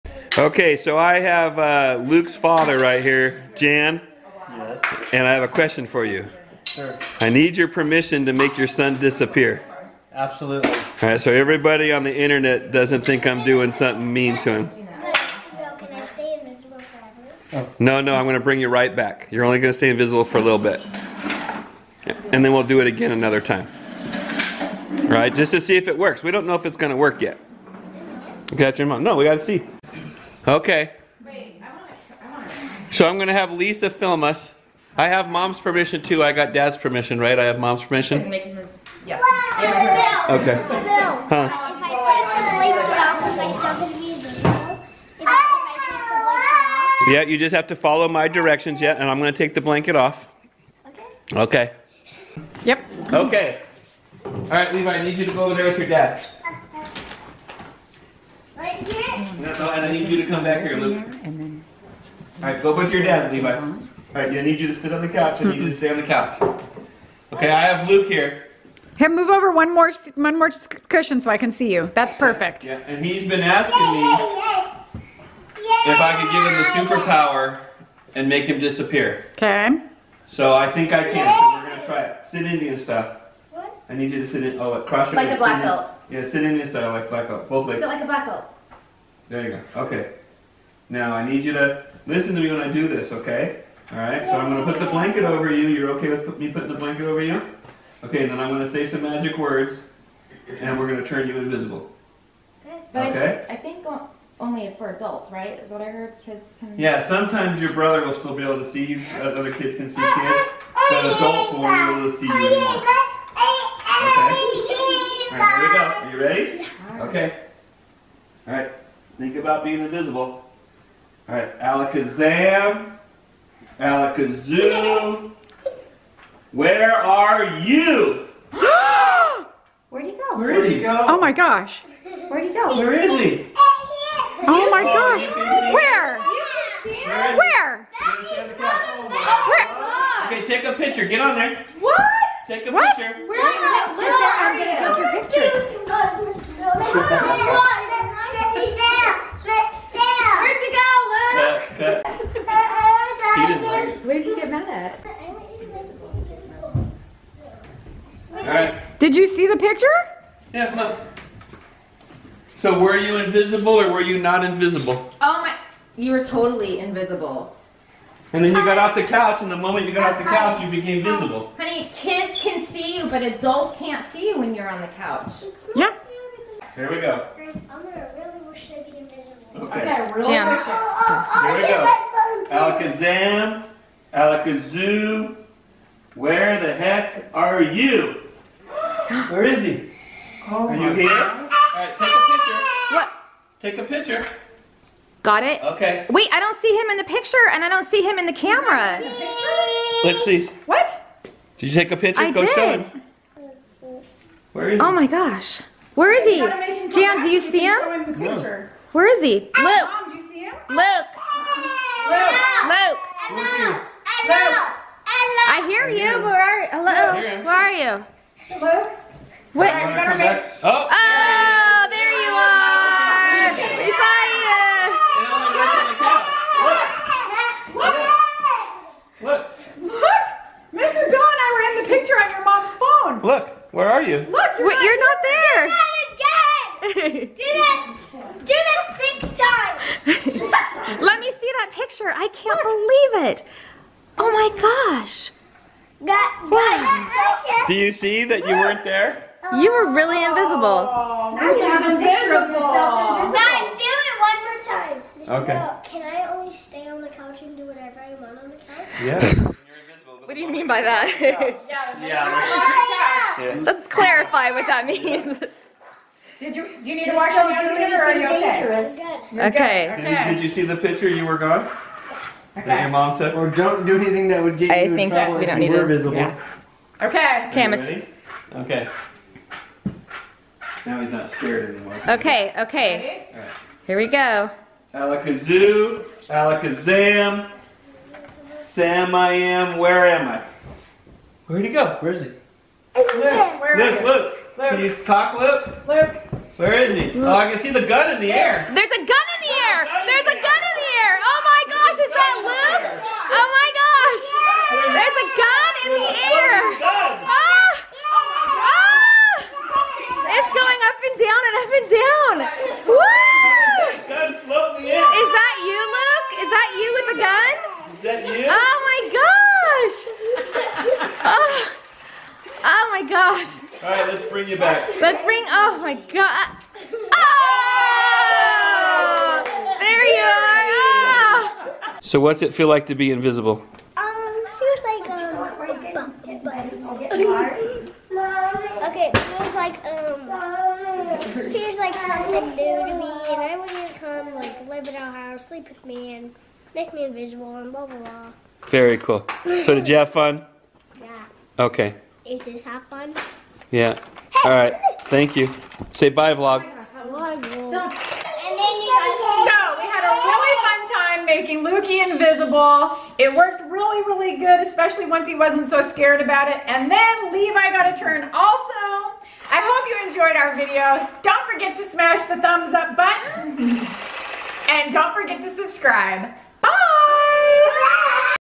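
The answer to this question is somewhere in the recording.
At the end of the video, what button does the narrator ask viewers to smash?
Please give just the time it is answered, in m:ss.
6:12.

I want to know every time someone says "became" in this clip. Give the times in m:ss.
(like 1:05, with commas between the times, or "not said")
2:50.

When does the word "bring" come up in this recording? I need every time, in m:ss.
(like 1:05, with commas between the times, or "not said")
0:18, 5:24.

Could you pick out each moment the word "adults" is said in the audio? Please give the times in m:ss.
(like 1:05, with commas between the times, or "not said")
1:44, 1:51, 2:53.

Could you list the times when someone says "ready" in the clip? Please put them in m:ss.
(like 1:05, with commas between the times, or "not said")
1:56, 4:37, 4:43.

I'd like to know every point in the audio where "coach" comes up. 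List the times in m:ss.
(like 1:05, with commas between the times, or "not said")
not said.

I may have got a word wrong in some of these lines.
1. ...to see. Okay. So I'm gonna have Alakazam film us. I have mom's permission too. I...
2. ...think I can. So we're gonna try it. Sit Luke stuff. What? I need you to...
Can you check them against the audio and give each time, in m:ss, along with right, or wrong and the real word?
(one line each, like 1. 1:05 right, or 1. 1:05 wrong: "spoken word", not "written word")
1. 0:29 wrong: "Lisa", not "Alakazam"
2. 1:20 wrong: "Indian", not "Luke".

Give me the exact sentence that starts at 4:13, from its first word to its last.
Guys, do it one more time.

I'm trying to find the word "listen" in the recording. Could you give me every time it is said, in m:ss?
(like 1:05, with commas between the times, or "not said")
1:32.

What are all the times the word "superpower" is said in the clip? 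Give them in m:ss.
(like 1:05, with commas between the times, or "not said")
1:16.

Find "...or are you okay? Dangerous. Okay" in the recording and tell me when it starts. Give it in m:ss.
4:28.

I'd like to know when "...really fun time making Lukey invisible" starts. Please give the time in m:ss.
6:00.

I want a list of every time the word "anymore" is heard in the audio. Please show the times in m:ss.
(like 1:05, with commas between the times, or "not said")
1:52, 4:41.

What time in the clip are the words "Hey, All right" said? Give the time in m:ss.
5:54.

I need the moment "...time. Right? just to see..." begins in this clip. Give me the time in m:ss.
0:23.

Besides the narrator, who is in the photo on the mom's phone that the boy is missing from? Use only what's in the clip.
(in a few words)
Mr. Bill.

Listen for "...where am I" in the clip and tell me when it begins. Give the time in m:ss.
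4:49.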